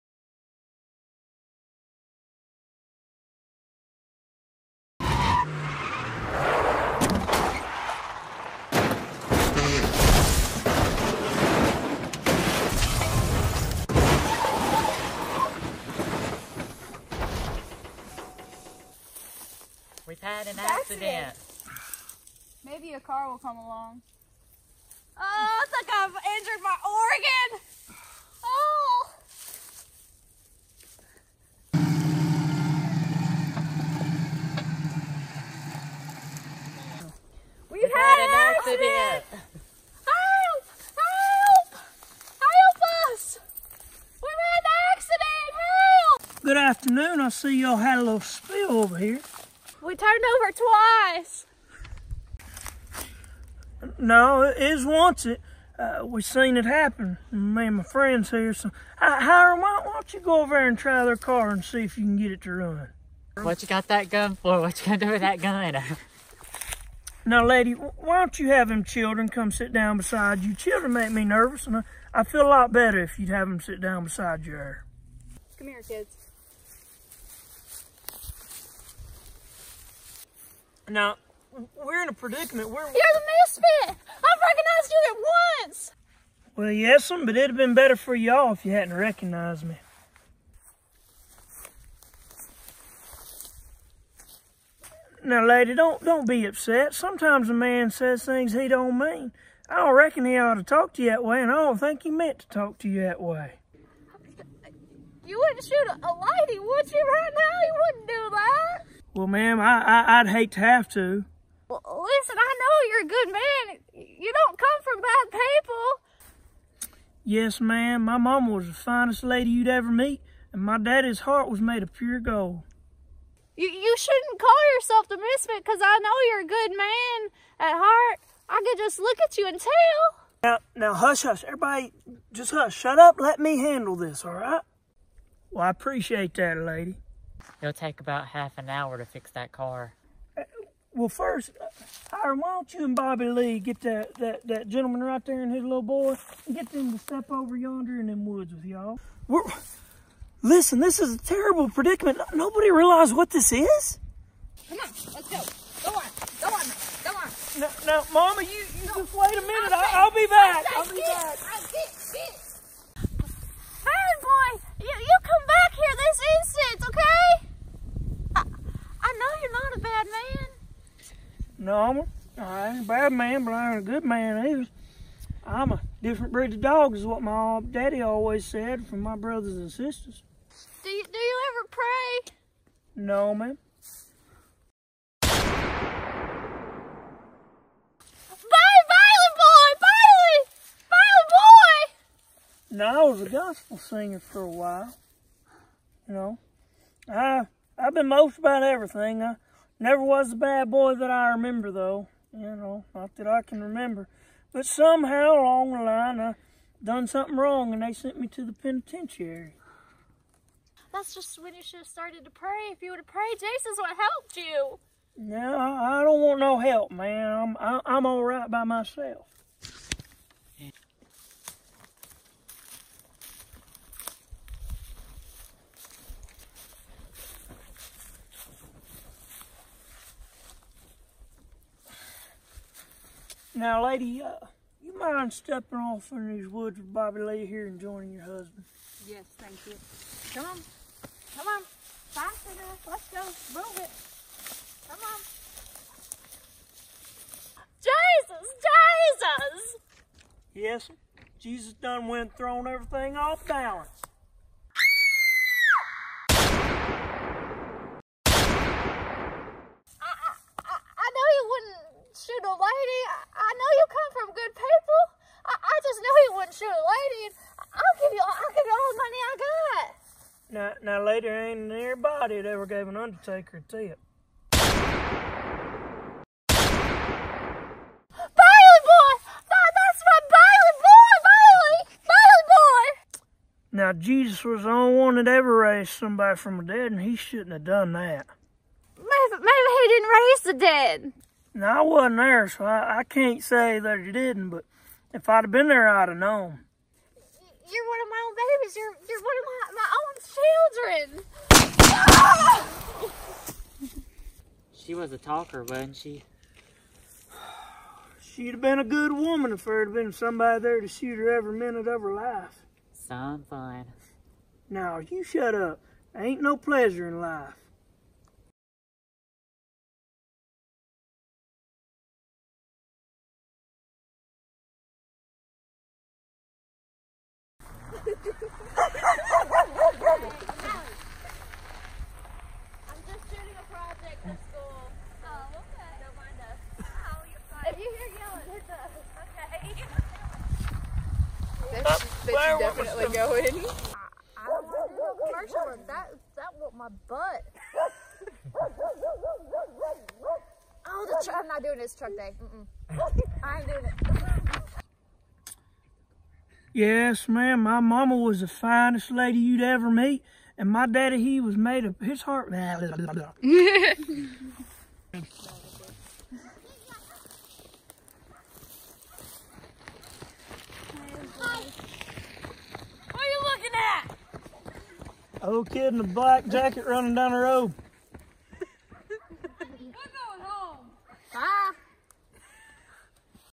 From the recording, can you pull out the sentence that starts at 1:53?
You don't come from bad people.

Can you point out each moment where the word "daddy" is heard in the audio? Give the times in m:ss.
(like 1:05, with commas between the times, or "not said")
2:00, 2:57, 6:00.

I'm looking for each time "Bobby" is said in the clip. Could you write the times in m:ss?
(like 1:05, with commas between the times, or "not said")
2:22, 3:56.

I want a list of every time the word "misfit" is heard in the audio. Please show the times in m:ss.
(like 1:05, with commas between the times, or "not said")
1:23, 2:05.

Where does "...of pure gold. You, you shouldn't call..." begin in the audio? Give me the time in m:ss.
2:01.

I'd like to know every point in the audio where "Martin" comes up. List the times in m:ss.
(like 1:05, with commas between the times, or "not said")
not said.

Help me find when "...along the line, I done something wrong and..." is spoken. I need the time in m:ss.
3:25.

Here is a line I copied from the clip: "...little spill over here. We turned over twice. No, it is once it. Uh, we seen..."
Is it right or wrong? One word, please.
right.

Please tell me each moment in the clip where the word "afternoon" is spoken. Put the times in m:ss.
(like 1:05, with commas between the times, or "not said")
0:46.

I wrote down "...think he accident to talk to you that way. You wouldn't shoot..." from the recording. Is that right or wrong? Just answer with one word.
wrong.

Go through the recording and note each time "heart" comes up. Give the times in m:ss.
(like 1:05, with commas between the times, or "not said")
2:01, 2:07, 6:02.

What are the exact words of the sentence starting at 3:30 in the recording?
That's just when you should have started to pray.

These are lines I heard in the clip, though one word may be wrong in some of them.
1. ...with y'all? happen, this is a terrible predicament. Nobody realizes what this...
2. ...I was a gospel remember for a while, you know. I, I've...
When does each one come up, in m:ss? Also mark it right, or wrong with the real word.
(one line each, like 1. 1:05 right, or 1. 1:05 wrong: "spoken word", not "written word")
1. 2:28 wrong: "listen", not "happen"
2. 3:13 wrong: "singer", not "remember".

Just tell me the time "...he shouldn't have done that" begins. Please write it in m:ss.
4:47.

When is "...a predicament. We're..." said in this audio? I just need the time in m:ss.
1:22.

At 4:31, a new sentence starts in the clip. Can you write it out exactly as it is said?
lady ain't nearby that ever gave an undertaker a tip.